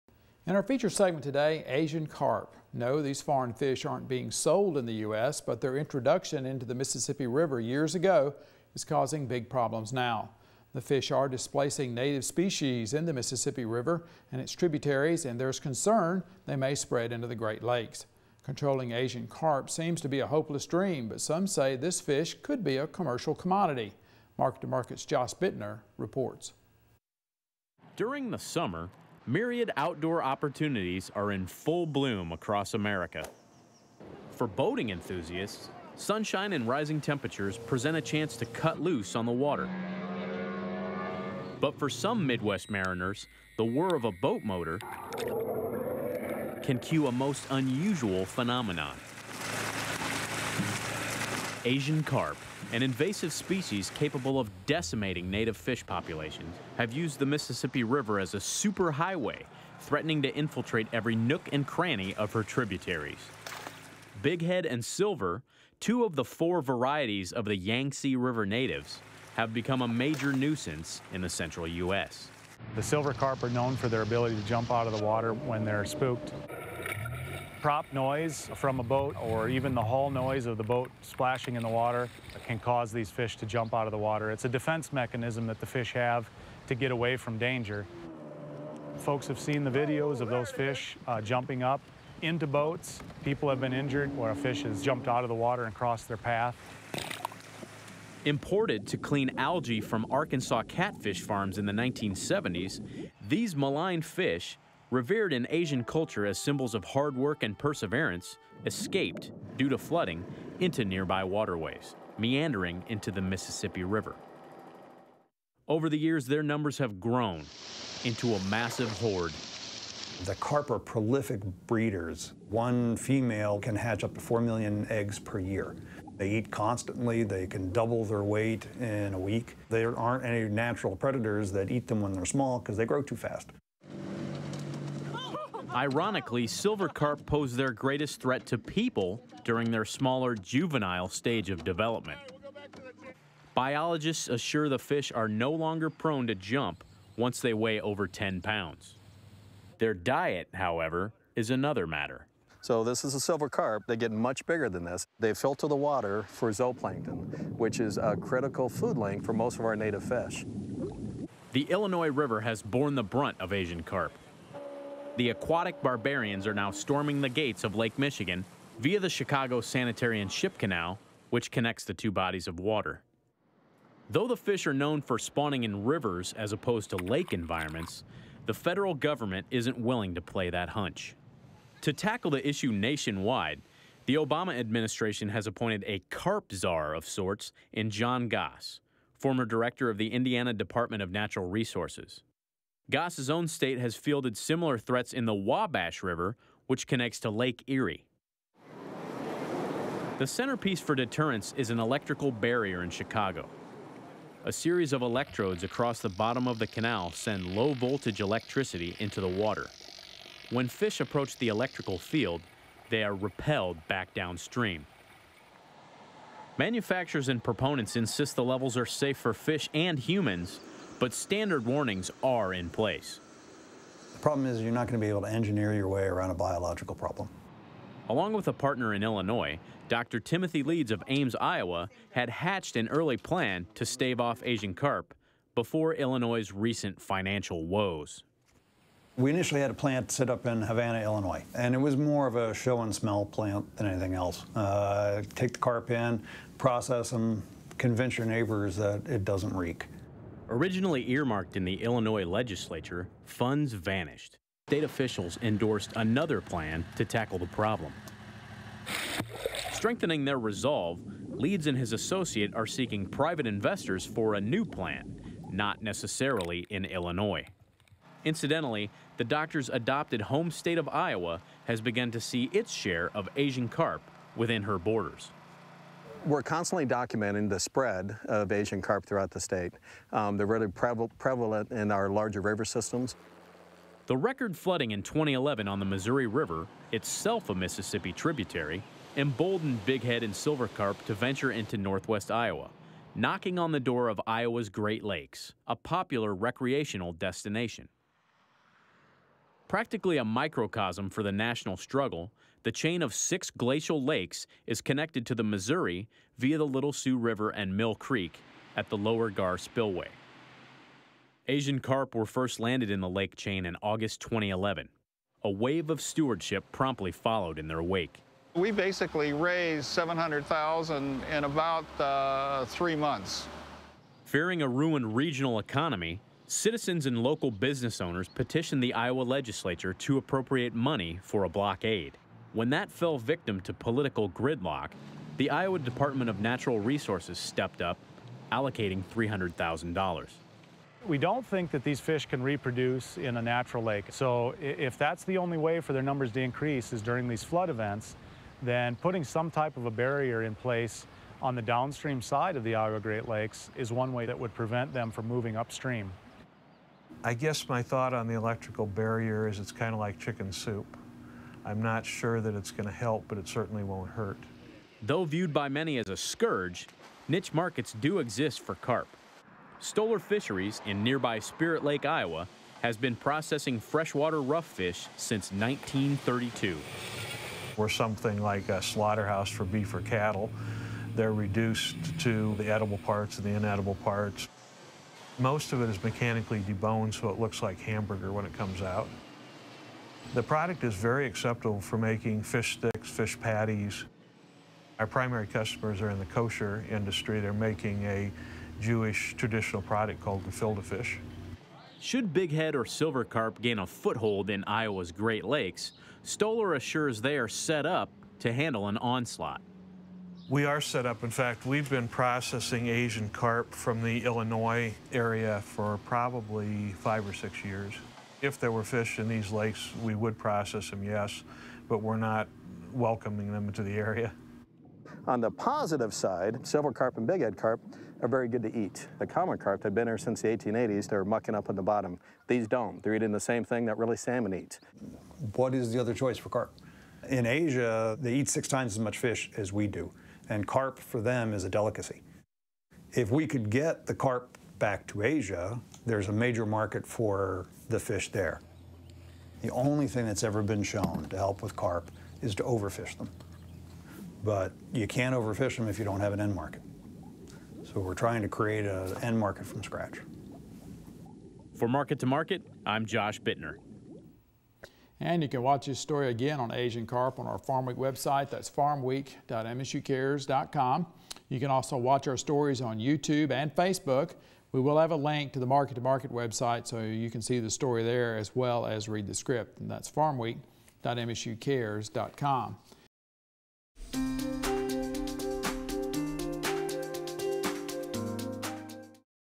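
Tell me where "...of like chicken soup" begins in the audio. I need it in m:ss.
5:59.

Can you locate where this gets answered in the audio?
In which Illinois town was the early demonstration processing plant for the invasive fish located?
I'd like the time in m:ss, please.
4:00.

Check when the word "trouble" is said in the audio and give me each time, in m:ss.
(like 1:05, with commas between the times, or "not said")
not said.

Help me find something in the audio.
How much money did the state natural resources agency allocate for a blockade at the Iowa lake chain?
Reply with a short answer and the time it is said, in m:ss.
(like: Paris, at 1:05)
$300,000, at 5:39.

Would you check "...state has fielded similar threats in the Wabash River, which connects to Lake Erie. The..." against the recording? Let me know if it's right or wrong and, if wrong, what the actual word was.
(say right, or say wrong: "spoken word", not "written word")
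right.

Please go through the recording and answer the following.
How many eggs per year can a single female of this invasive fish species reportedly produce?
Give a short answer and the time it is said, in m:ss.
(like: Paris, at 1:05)
4 million, at 2:04.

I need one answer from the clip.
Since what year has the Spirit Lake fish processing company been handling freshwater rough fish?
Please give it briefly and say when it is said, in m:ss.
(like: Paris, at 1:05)
1932, at 6:15.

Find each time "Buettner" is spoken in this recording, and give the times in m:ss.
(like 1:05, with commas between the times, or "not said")
0:25, 7:43.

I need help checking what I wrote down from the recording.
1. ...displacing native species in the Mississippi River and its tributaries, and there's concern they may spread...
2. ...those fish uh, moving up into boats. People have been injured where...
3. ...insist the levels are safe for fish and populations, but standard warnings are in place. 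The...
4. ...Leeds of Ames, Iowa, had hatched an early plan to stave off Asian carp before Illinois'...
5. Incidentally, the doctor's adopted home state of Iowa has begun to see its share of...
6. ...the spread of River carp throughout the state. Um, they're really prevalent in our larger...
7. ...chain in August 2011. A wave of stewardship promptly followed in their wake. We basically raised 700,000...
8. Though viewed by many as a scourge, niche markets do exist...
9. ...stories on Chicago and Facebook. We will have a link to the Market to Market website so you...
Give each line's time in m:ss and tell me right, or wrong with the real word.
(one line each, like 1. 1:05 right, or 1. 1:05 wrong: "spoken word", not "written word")
1. 0:11 right
2. 1:30 wrong: "jumping", not "moving"
3. 3:37 wrong: "humans", not "populations"
4. 3:50 right
5. 4:28 right
6. 4:37 wrong: "Asian", not "River"
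7. 5:13 right
8. 6:05 right
9. 7:52 wrong: "YouTube", not "Chicago".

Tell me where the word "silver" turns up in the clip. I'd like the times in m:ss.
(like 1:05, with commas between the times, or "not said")
1:04, 1:12, 2:16, 2:33, 4:50, 6:42, 7:06.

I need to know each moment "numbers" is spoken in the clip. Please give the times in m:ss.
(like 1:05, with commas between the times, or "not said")
1:56, 5:46.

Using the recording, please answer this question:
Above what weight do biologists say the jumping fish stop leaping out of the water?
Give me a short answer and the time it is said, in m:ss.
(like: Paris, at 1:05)
10 pounds, at 2:28.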